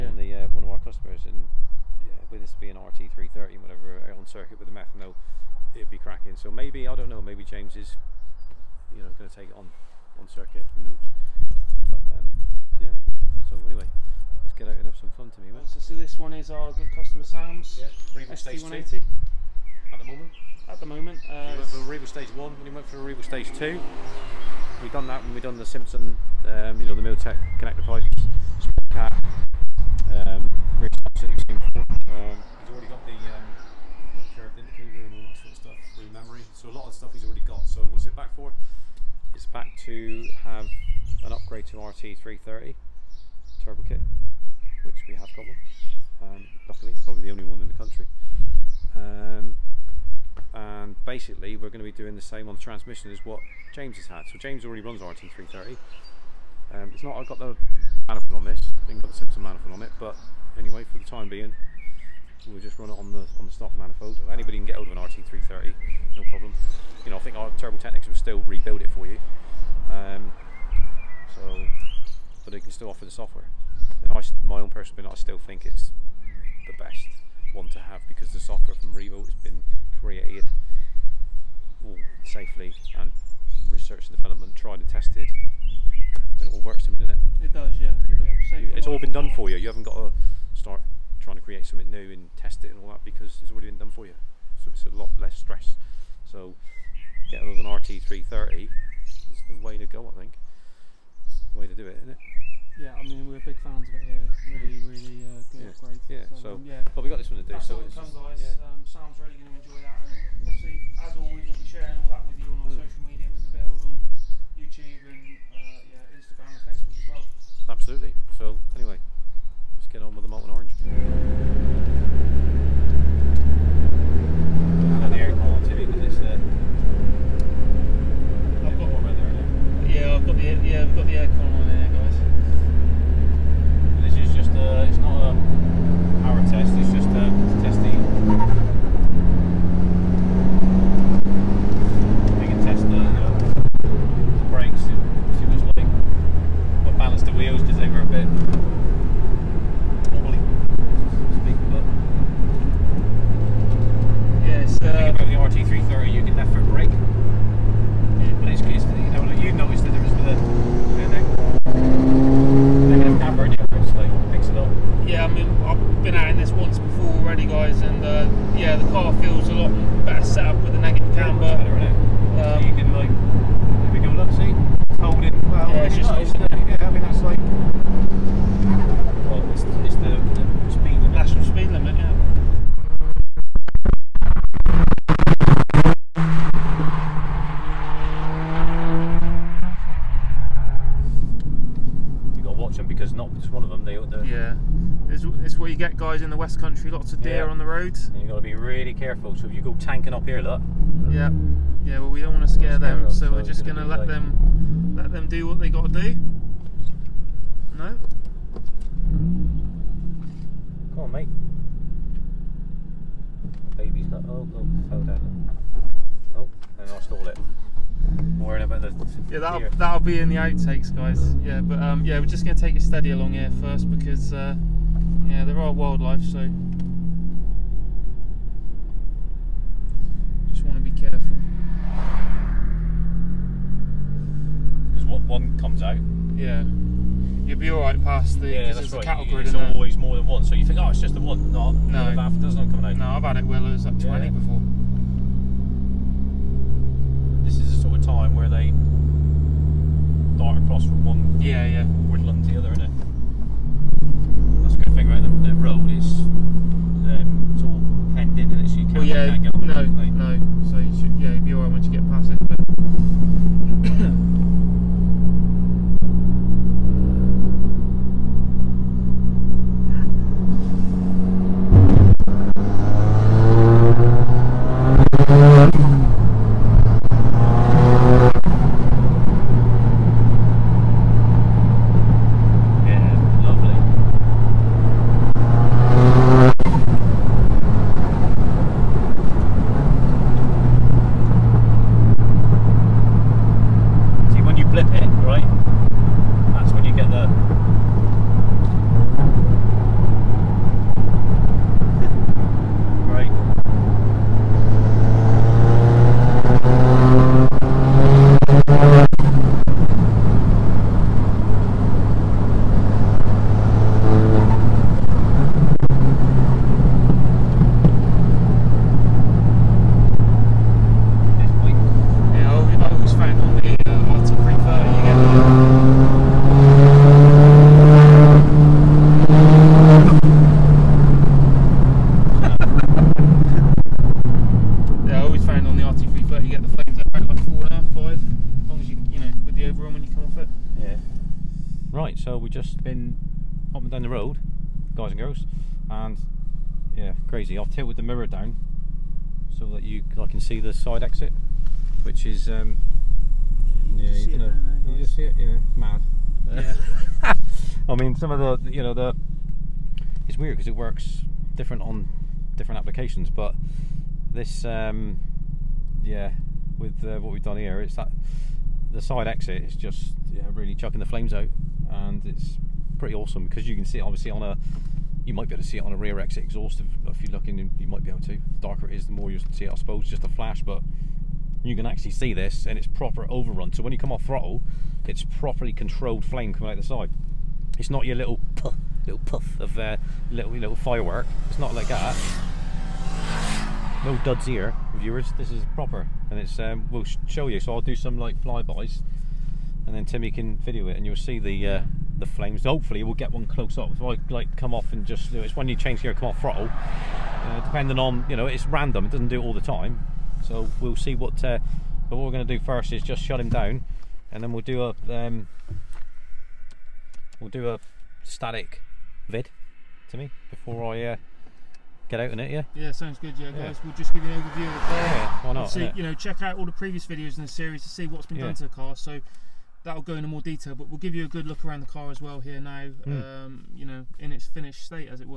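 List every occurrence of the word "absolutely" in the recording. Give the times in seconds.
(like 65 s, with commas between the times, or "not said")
31 s, 117 s.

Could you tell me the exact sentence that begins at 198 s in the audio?
And you've got to be really careful.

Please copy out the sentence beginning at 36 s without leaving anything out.
So a lot of stuff he's already got.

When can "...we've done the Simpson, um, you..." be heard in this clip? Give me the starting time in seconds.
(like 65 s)
25 s.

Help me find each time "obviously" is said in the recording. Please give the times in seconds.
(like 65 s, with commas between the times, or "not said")
110 s, 374 s.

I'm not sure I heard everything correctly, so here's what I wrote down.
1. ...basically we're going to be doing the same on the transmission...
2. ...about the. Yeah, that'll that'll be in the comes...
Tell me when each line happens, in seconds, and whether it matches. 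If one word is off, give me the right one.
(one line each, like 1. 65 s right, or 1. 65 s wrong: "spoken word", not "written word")
1. 51 s right
2. 218 s wrong: "outtakes", not "comes".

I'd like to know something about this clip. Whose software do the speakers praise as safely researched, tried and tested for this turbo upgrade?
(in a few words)
Revo.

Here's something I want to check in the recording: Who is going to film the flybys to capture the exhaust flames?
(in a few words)
Timmy.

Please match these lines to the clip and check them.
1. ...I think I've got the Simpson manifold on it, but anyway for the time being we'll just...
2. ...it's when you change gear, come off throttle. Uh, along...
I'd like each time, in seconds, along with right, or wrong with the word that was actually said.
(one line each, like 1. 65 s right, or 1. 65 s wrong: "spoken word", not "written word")
1. 58 s right
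2. 405 s wrong: "depending", not "along".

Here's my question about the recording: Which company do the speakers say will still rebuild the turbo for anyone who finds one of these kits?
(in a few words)
Turbo Technics.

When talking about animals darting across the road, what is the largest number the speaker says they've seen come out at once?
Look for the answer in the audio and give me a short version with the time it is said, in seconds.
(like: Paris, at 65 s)
20, at 243 s.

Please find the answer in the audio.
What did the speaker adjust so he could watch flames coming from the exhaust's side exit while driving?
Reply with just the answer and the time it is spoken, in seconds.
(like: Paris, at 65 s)
The mirror, at 347 s.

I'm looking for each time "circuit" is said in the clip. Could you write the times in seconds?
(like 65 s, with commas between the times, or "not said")
4 s, 10 s.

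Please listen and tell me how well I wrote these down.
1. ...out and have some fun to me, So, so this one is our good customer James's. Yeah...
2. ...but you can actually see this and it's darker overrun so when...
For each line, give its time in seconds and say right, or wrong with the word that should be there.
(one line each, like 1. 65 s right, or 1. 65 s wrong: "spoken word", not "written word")
1. 14 s wrong: "Sam", not "James"
2. 380 s wrong: "proper", not "darker".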